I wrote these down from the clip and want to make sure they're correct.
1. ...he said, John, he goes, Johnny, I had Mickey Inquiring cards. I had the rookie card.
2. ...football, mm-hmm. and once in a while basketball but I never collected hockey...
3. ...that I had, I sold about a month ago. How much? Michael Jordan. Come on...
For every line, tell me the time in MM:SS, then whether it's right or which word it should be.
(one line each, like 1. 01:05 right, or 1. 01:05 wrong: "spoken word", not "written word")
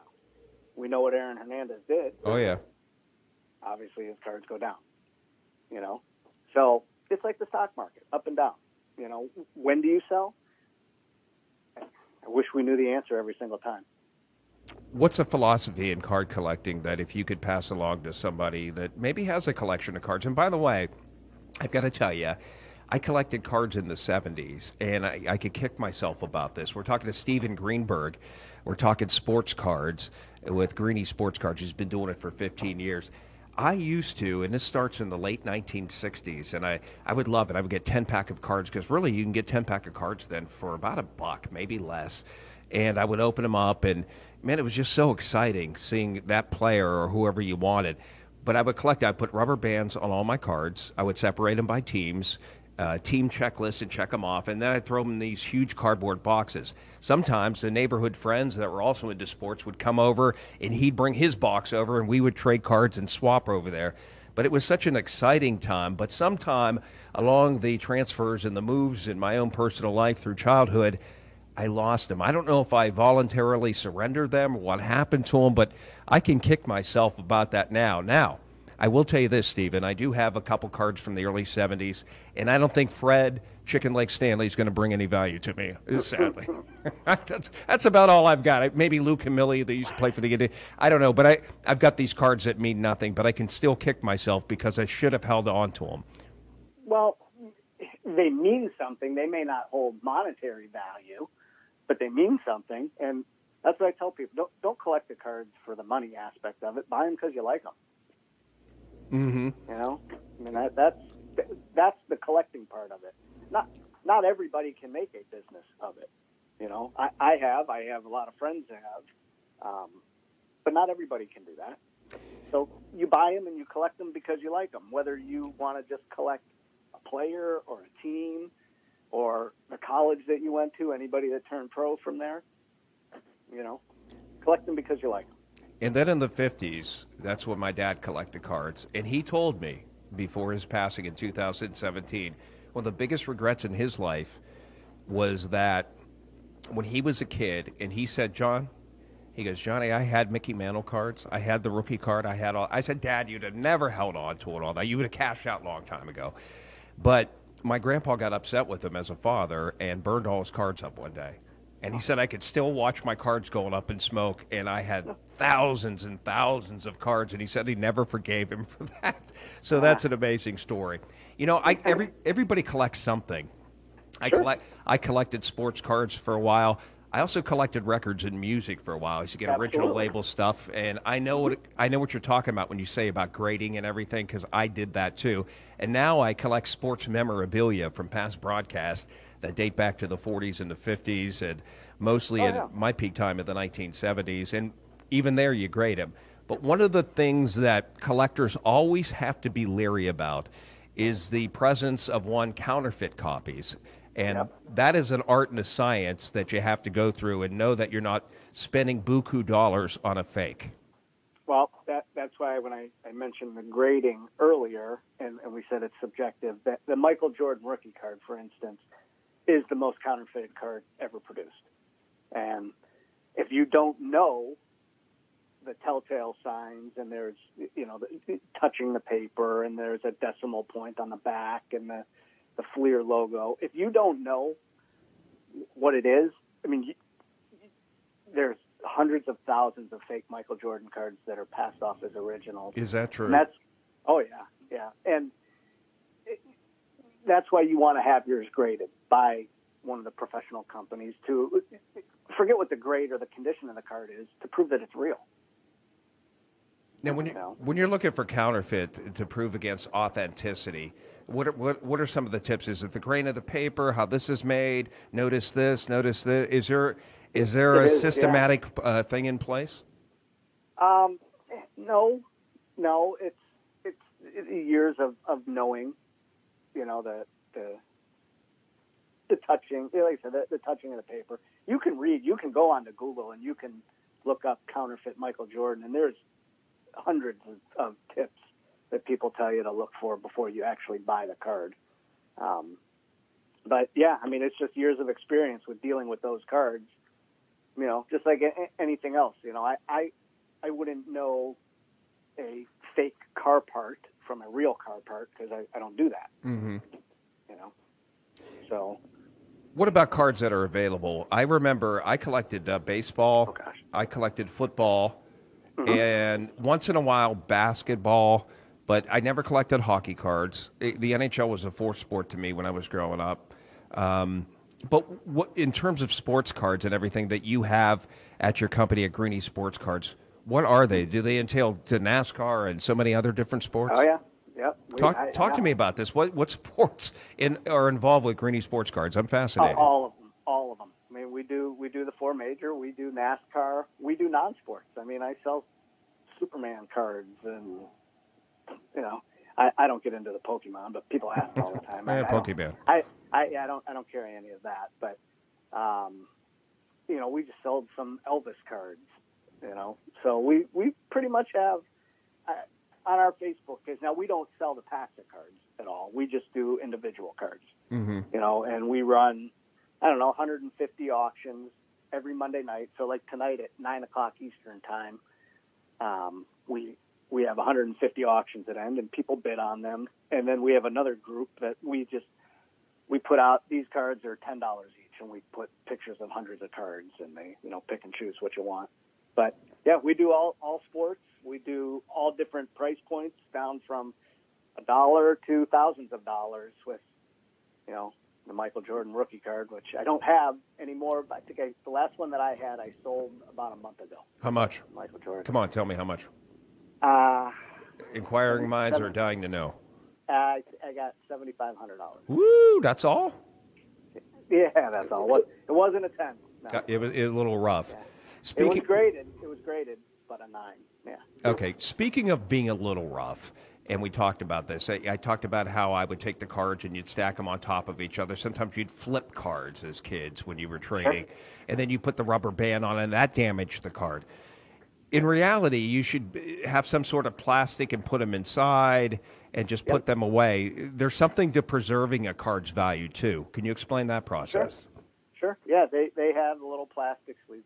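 1. 02:27 wrong: "Mantle", not "Inquiring"
2. 05:14 right
3. 06:42 right.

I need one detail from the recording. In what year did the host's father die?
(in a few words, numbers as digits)
2017.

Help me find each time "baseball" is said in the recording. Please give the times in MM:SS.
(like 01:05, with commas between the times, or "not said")
05:12.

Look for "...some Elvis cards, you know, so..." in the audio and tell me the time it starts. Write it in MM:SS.
05:57.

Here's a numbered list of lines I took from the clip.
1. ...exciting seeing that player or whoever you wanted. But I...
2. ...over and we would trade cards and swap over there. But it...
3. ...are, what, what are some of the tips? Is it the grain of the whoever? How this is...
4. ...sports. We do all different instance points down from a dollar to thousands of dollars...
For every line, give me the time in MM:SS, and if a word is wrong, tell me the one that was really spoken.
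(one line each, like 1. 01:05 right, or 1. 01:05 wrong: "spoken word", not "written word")
1. 00:45 right
2. 01:01 right
3. 04:21 wrong: "paper", not "whoever"
4. 06:30 wrong: "price", not "instance".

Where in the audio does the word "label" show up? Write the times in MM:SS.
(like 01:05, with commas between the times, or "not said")
02:59.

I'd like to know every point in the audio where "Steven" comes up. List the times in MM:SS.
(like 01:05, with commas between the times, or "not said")
00:27, 01:19.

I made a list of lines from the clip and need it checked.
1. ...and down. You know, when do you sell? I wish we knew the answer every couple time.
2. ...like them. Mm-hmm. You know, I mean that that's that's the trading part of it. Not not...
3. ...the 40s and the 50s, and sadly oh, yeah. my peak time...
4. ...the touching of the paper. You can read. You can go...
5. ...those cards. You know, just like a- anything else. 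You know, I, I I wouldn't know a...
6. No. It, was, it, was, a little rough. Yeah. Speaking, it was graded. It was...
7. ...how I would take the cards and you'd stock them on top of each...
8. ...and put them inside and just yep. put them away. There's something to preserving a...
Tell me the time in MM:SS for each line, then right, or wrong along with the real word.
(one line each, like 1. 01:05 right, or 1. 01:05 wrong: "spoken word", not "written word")
1. 00:08 wrong: "single", not "couple"
2. 01:47 wrong: "collecting", not "trading"
3. 03:10 wrong: "mostly", not "sadly"
4. 04:40 right
5. 04:56 right
6. 06:56 right
7. 07:05 wrong: "stack", not "stock"
8. 07:17 right.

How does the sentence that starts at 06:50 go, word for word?
Uh, I, I got seventy five hundred dollars.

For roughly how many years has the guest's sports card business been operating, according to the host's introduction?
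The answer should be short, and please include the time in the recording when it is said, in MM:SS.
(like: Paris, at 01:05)
15 years, at 00:32.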